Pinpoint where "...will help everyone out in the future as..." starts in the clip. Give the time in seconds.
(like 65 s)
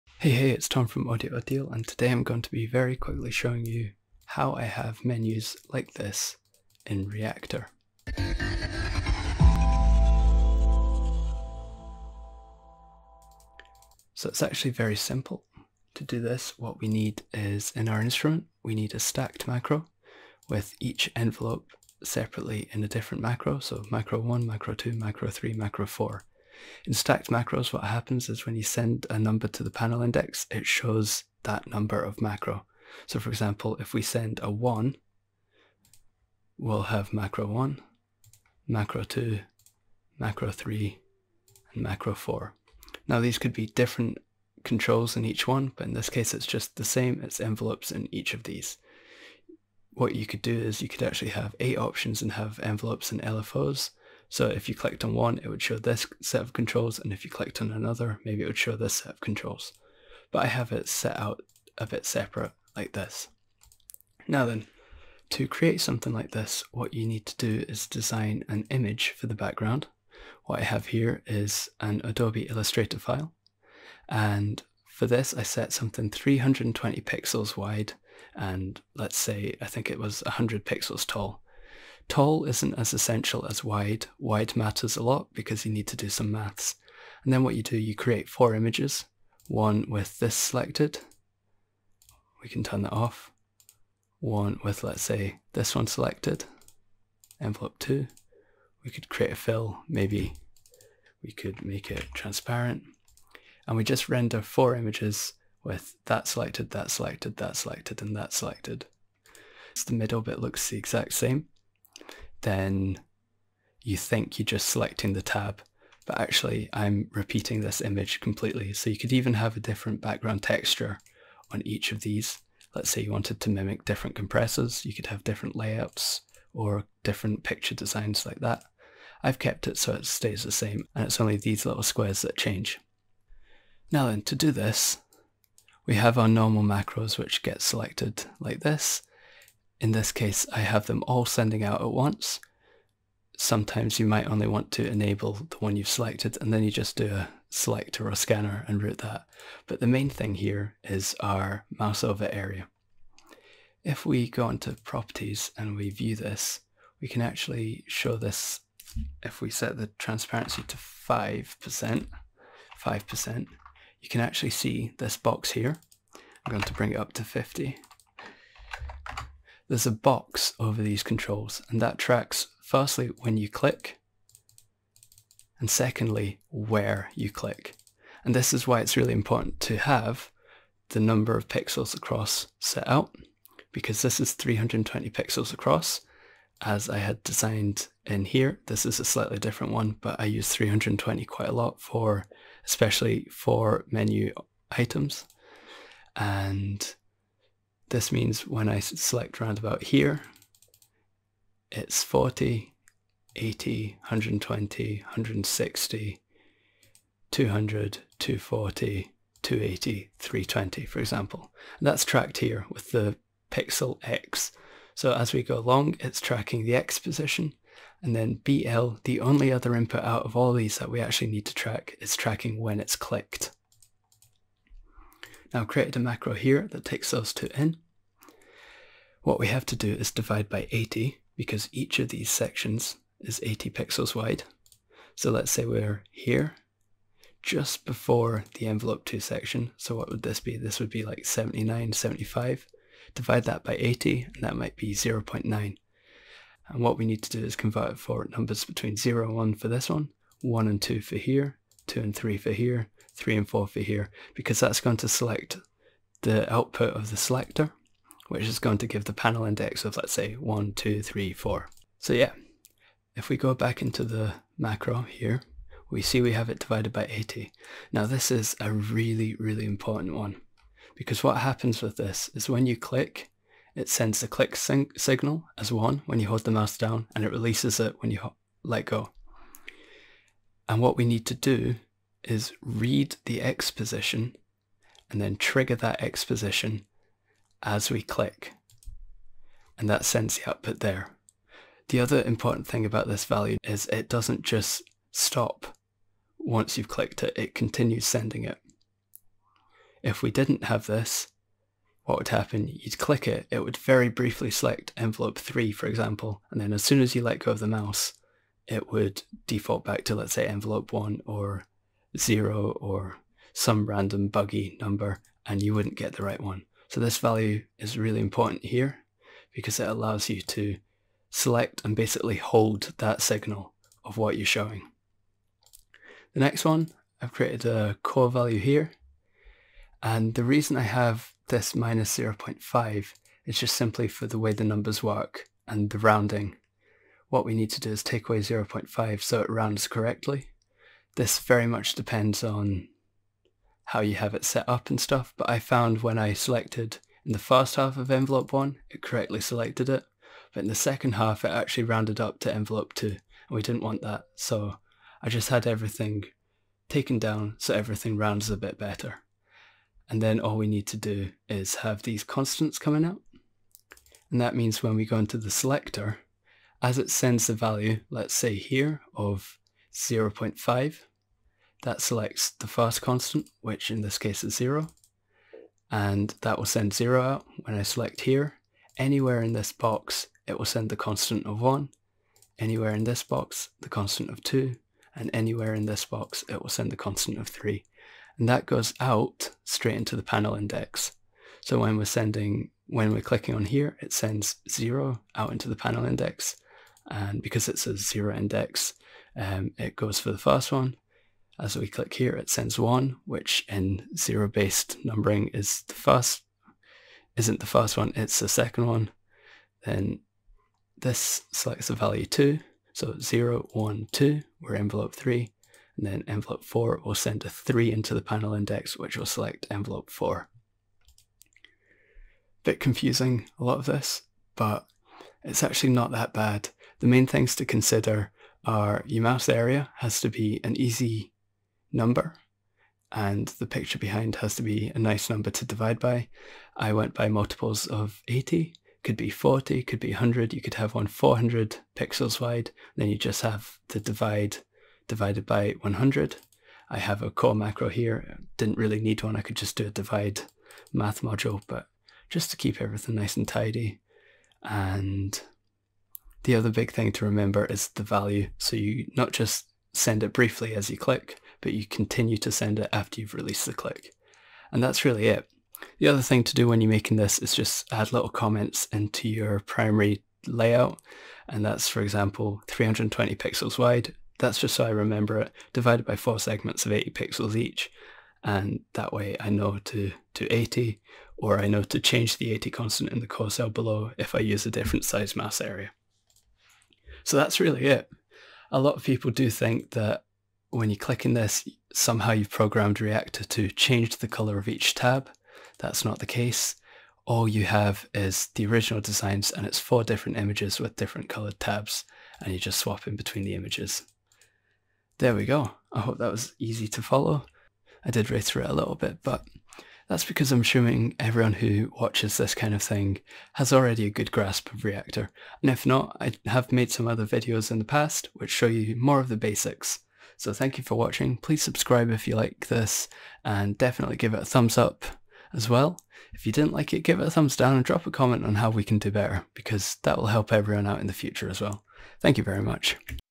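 530 s.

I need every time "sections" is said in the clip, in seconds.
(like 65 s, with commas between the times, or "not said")
232 s, 239 s.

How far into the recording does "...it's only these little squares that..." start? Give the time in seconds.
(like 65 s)
131 s.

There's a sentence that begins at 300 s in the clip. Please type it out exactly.
If we didn't have this, what would happen?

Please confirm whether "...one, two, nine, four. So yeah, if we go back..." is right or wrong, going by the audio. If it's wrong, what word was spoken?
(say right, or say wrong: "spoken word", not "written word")
wrong: "three", not "nine".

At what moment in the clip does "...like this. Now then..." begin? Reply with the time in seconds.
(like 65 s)
62 s.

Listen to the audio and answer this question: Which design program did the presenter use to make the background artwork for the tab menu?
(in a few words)
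Adobe Illustrator.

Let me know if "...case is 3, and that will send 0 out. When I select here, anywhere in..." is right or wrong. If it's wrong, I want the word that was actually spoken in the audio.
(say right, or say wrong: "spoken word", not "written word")
wrong: "0", not "3".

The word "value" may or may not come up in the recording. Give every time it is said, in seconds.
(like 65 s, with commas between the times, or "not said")
293 s, 317 s, 328 s, 367 s, 411 s, 458 s.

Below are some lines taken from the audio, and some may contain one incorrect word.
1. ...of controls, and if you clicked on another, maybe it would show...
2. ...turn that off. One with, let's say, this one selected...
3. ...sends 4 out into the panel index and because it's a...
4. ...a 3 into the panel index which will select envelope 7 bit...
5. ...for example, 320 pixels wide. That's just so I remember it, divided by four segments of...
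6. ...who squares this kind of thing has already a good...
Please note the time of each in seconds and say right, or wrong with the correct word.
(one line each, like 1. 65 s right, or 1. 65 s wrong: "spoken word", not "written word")
1. 56 s right
2. 92 s right
3. 394 s wrong: "0", not "4"
4. 417 s wrong: "4", not "7"
5. 471 s right
6. 511 s wrong: "watches", not "squares".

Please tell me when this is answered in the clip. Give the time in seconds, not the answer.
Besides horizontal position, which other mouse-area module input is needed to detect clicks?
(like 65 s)
218 s.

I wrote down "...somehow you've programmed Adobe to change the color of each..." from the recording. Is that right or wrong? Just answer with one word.
wrong.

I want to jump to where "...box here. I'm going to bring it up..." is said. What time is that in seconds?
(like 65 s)
165 s.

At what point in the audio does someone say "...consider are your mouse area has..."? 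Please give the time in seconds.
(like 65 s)
427 s.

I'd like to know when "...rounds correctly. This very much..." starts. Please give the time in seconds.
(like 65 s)
339 s.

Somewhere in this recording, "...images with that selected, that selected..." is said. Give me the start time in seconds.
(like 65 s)
104 s.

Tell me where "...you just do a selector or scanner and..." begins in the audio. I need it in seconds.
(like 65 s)
146 s.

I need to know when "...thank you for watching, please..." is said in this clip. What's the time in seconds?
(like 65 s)
520 s.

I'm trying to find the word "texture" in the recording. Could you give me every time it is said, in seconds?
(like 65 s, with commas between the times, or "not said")
120 s.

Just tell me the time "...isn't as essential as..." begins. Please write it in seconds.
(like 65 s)
82 s.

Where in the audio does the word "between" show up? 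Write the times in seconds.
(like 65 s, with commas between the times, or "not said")
248 s, 503 s.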